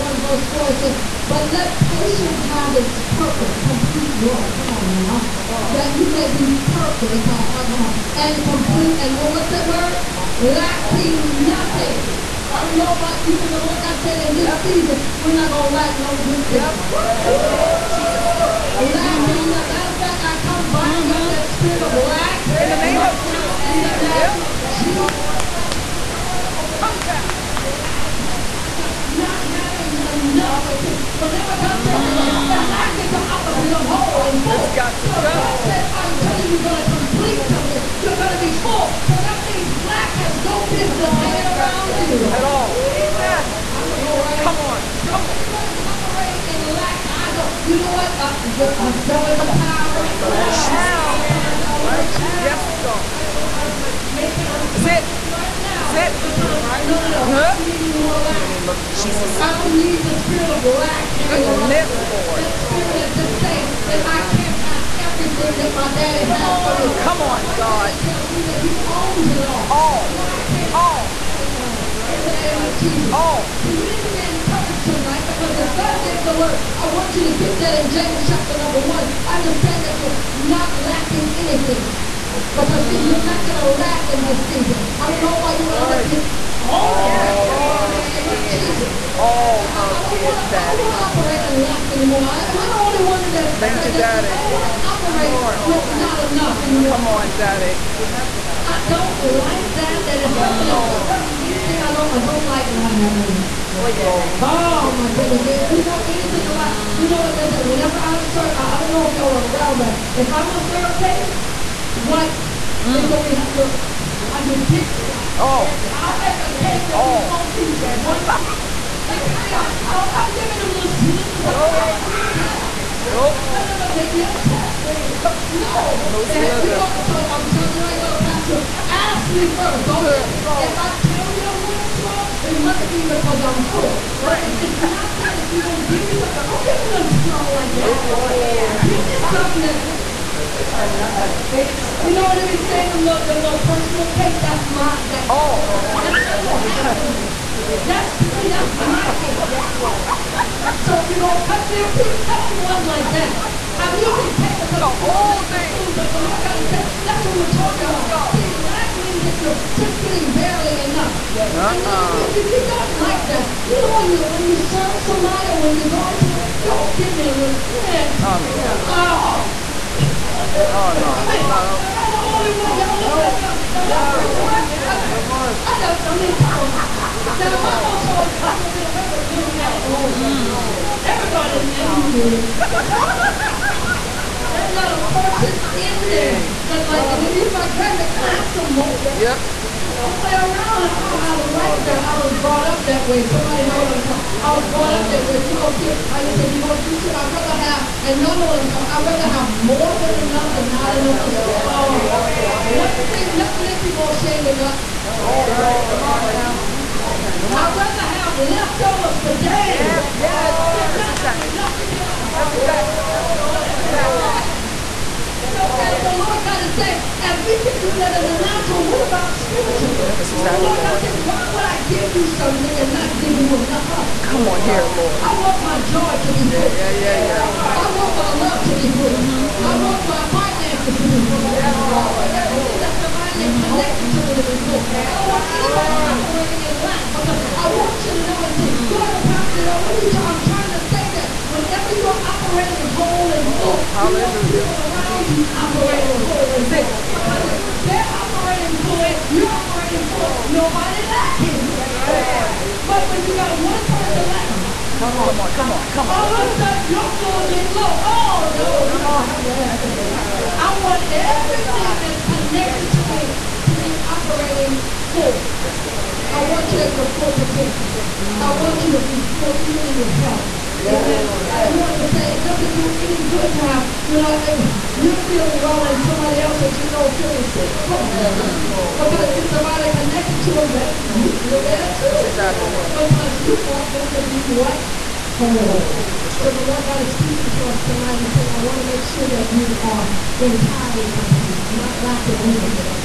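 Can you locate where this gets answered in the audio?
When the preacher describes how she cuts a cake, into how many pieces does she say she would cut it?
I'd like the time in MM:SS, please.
01:57.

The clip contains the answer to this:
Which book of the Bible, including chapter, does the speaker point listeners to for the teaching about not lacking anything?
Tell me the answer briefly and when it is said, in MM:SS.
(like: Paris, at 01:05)
James 1, at 01:17.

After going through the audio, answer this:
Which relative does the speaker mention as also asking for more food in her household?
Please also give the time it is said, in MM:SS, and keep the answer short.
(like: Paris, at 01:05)
grandma, at 03:07.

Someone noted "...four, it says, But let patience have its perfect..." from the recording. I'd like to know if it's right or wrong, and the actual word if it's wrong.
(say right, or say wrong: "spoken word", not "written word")
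right.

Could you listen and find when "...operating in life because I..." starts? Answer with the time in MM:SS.
03:56.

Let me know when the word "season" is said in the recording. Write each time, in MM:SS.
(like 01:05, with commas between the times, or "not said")
00:14, 01:24.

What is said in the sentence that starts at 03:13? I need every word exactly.
Somebody know what I'm talking I was brought up that way.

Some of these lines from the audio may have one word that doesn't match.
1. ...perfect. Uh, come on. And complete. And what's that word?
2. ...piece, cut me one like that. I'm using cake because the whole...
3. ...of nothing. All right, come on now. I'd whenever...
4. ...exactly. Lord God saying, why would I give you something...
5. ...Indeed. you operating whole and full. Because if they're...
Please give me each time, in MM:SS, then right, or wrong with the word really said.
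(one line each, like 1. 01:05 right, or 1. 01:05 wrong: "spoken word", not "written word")
1. 00:06 right
2. 02:31 right
3. 03:24 wrong: "rather", not "whenever"
4. 03:40 right
5. 04:05 right.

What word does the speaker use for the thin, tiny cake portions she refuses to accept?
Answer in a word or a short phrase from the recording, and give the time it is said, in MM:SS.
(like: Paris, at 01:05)
slithers, at 02:00.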